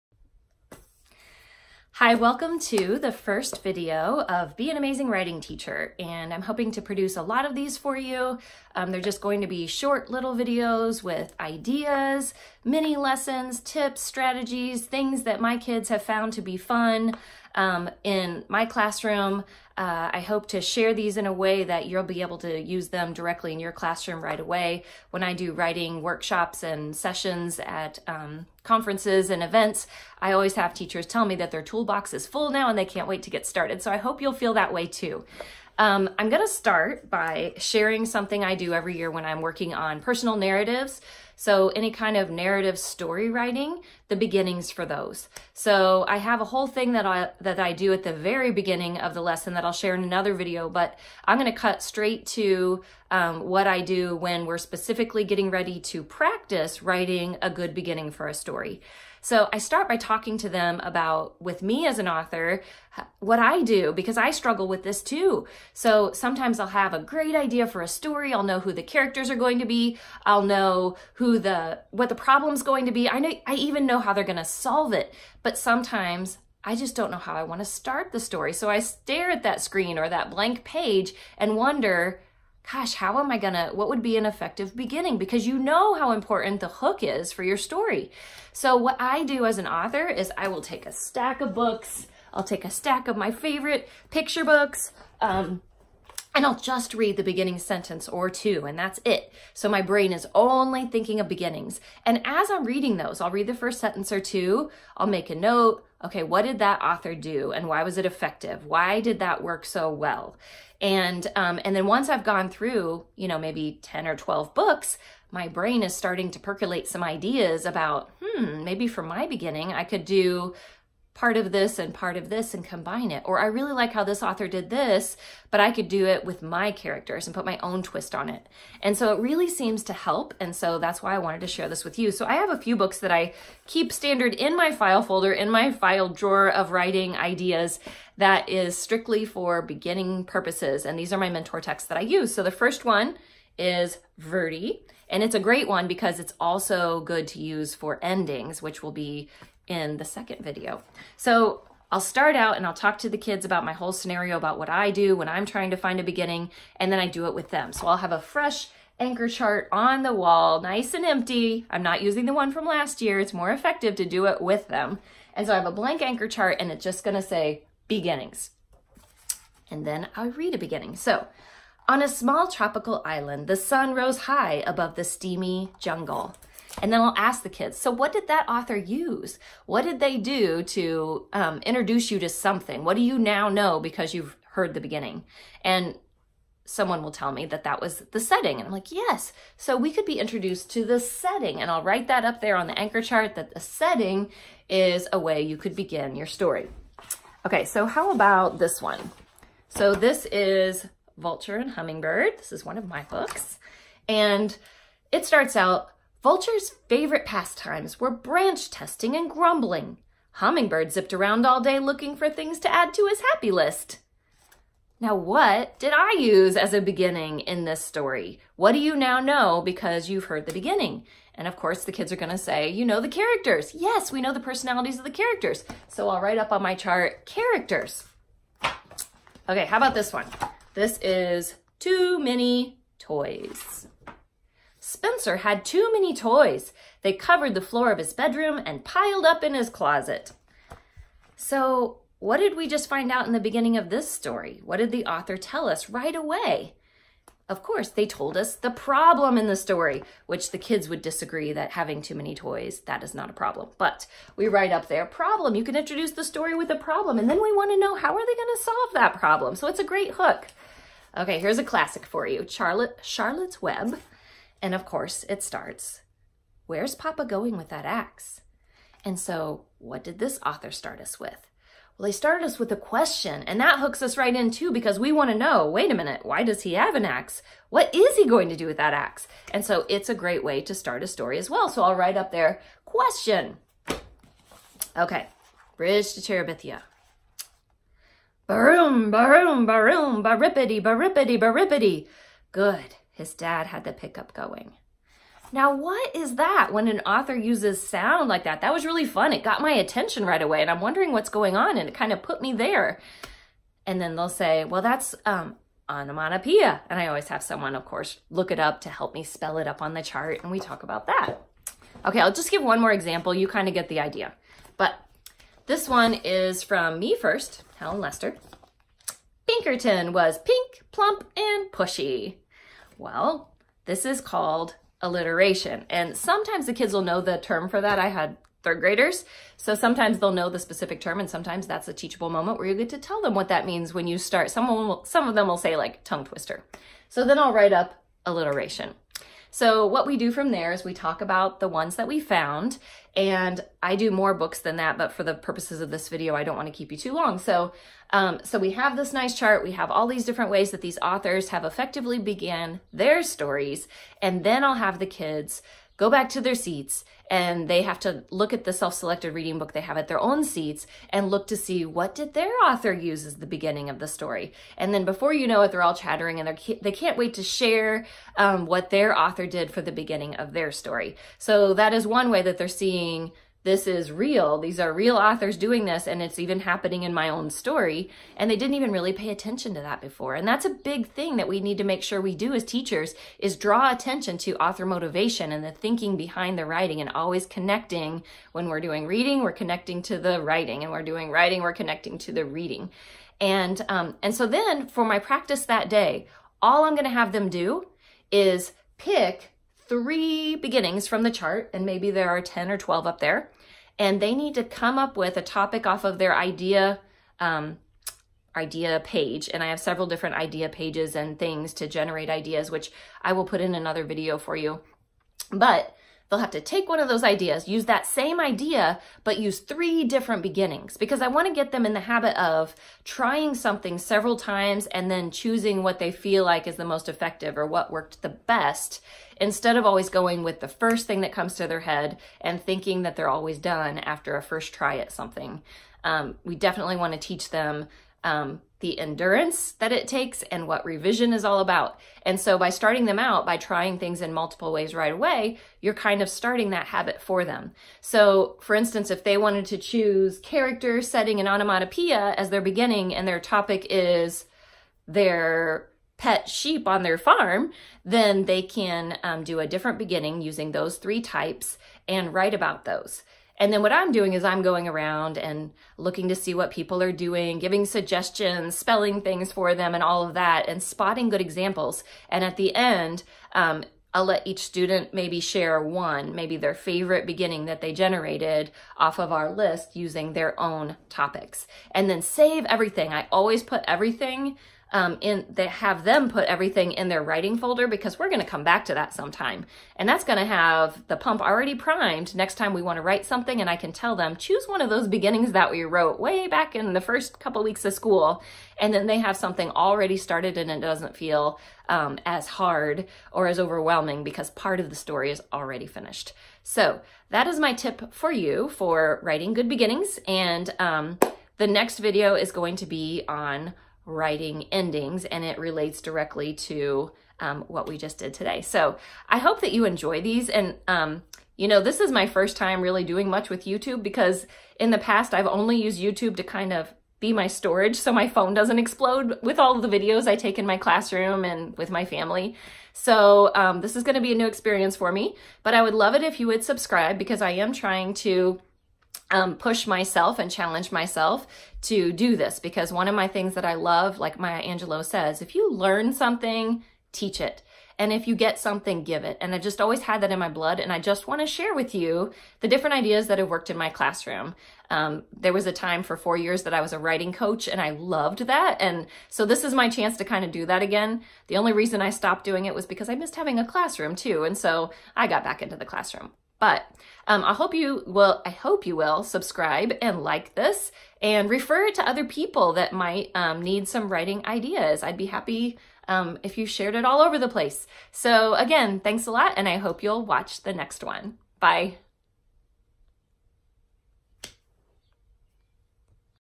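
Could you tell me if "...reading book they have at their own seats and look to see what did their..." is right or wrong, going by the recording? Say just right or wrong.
right.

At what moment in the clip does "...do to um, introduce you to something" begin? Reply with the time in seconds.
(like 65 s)
180 s.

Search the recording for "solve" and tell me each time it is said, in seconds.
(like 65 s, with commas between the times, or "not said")
74 s, 258 s.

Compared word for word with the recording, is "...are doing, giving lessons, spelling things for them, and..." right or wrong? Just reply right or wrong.
wrong.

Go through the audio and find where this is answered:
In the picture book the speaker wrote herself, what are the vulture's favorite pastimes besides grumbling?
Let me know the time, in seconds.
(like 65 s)
208 s.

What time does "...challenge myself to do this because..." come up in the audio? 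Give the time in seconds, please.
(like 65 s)
540 s.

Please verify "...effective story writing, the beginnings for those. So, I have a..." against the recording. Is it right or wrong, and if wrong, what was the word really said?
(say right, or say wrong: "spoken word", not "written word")
wrong: "narrative", not "effective".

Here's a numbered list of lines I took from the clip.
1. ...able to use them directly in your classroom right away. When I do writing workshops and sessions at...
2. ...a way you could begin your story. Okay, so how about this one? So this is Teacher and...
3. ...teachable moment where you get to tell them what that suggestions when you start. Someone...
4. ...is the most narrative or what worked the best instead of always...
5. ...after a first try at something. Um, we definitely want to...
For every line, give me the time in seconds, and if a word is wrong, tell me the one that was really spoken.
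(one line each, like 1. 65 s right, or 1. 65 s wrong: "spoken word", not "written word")
1. 22 s right
2. 195 s wrong: "Vulture", not "Teacher"
3. 331 s wrong: "means", not "suggestions"
4. 426 s wrong: "effective", not "narrative"
5. 433 s right.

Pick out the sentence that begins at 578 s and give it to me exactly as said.
So again, thanks a lot and I hope you'll watch the next one.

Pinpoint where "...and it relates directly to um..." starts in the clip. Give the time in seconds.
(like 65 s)
515 s.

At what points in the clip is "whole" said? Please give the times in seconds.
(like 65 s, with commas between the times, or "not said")
46 s, 153 s.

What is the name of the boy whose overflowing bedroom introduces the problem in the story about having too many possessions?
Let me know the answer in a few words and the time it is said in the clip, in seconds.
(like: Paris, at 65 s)
Spencer, at 234 s.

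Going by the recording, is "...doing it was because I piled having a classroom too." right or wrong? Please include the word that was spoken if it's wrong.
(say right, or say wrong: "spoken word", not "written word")
wrong: "missed", not "piled".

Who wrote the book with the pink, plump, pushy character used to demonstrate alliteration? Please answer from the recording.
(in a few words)
Helen Lester.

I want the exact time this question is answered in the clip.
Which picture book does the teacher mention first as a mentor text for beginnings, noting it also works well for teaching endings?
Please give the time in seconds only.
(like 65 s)
144 s.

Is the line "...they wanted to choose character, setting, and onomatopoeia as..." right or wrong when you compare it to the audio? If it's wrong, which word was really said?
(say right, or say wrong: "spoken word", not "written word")
right.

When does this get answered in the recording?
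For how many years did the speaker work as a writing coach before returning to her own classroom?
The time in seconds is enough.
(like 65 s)
556 s.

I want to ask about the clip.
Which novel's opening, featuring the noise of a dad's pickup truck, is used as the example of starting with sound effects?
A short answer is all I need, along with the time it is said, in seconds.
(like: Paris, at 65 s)
Bridge to Terabithia, at 285 s.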